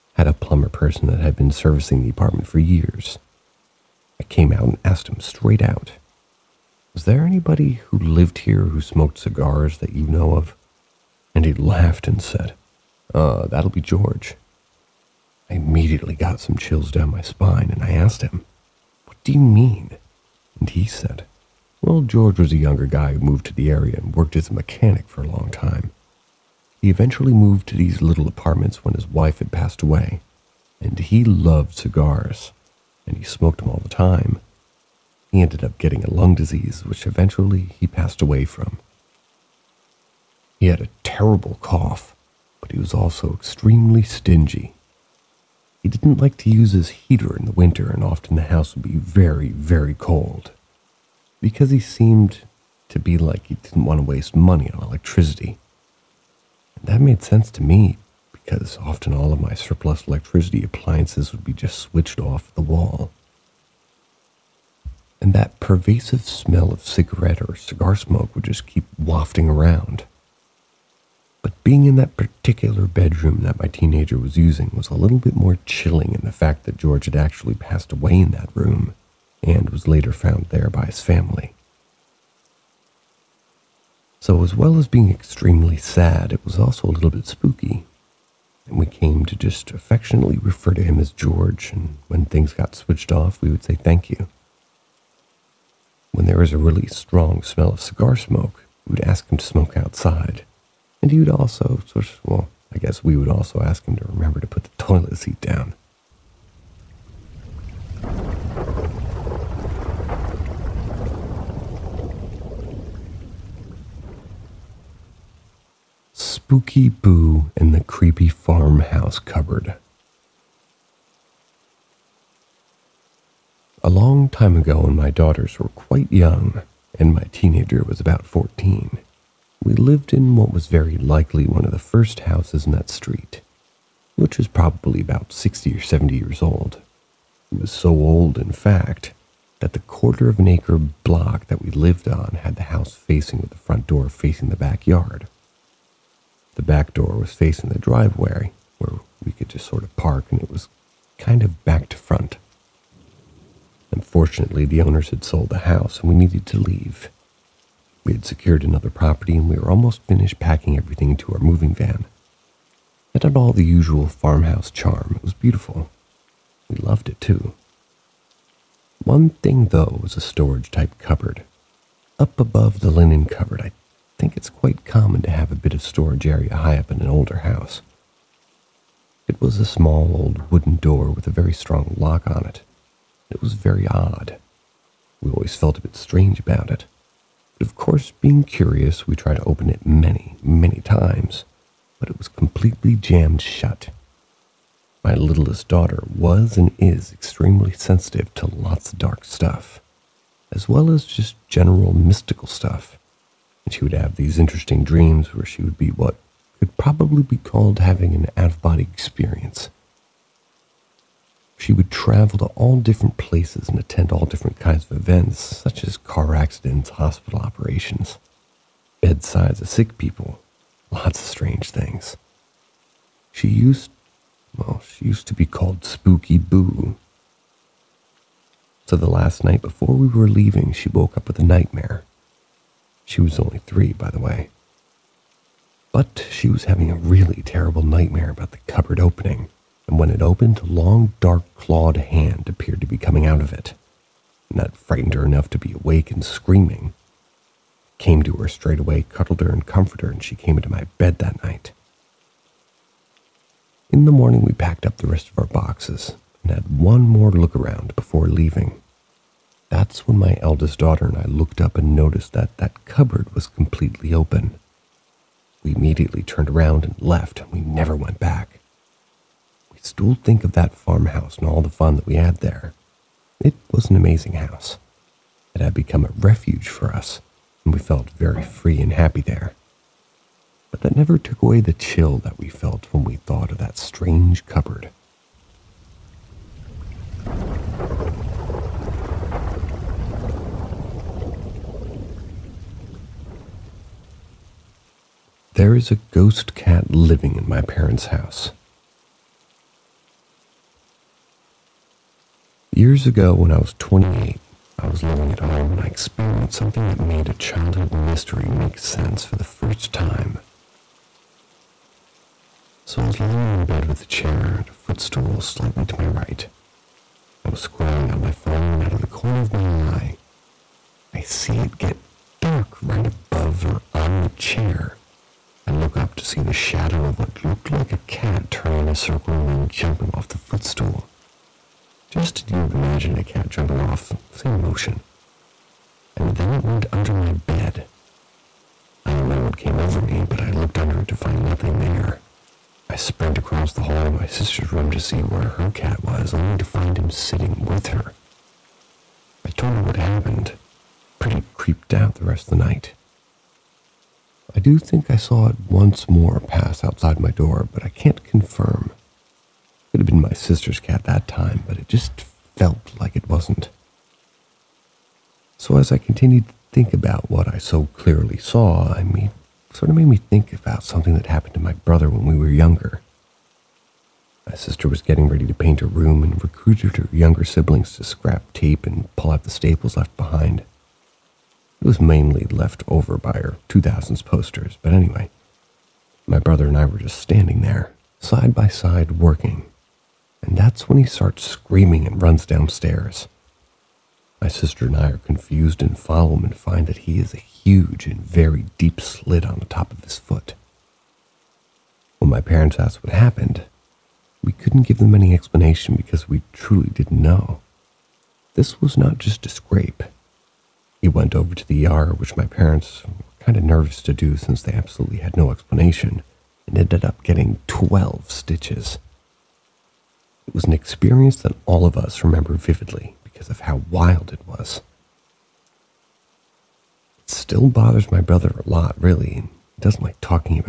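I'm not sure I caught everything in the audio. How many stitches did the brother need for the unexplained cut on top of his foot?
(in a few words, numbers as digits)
12.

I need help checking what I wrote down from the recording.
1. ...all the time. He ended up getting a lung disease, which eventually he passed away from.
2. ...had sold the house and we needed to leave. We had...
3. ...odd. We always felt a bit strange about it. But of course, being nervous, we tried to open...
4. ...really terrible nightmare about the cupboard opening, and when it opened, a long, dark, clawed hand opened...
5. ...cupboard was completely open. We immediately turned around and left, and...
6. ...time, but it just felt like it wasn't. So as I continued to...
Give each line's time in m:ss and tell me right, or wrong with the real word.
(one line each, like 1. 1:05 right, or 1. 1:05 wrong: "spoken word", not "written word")
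1. 0:33 right
2. 2:35 right
3. 3:03 wrong: "curious", not "nervous"
4. 3:56 wrong: "appeared", not "opened"
5. 4:22 right
6. 6:01 right.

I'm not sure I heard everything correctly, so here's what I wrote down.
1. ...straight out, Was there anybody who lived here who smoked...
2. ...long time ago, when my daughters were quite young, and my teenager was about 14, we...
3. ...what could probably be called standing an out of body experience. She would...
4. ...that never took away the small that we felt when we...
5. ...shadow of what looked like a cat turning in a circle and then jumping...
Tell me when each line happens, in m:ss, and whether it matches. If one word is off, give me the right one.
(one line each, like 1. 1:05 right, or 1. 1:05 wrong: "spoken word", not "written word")
1. 0:05 right
2. 2:03 right
3. 3:25 wrong: "having", not "standing"
4. 4:40 wrong: "chill", not "small"
5. 5:26 right.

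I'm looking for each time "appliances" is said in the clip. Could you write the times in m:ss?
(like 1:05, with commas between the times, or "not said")
1:00.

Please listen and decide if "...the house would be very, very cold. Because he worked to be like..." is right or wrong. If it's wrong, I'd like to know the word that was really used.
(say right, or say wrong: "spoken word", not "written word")
wrong: "seemed", not "worked".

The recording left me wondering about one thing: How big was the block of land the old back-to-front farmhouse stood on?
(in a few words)
Quarter of an acre.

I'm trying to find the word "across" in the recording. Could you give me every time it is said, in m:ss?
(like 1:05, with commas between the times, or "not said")
5:43.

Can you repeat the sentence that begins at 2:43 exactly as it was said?
It had all the usual farmhouse charm.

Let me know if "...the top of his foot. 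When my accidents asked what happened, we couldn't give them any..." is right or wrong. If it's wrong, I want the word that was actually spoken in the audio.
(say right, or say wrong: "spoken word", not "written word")
wrong: "parents", not "accidents".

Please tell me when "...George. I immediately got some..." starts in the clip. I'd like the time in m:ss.
0:13.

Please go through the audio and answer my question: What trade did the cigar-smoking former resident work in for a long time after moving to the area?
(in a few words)
Mechanic.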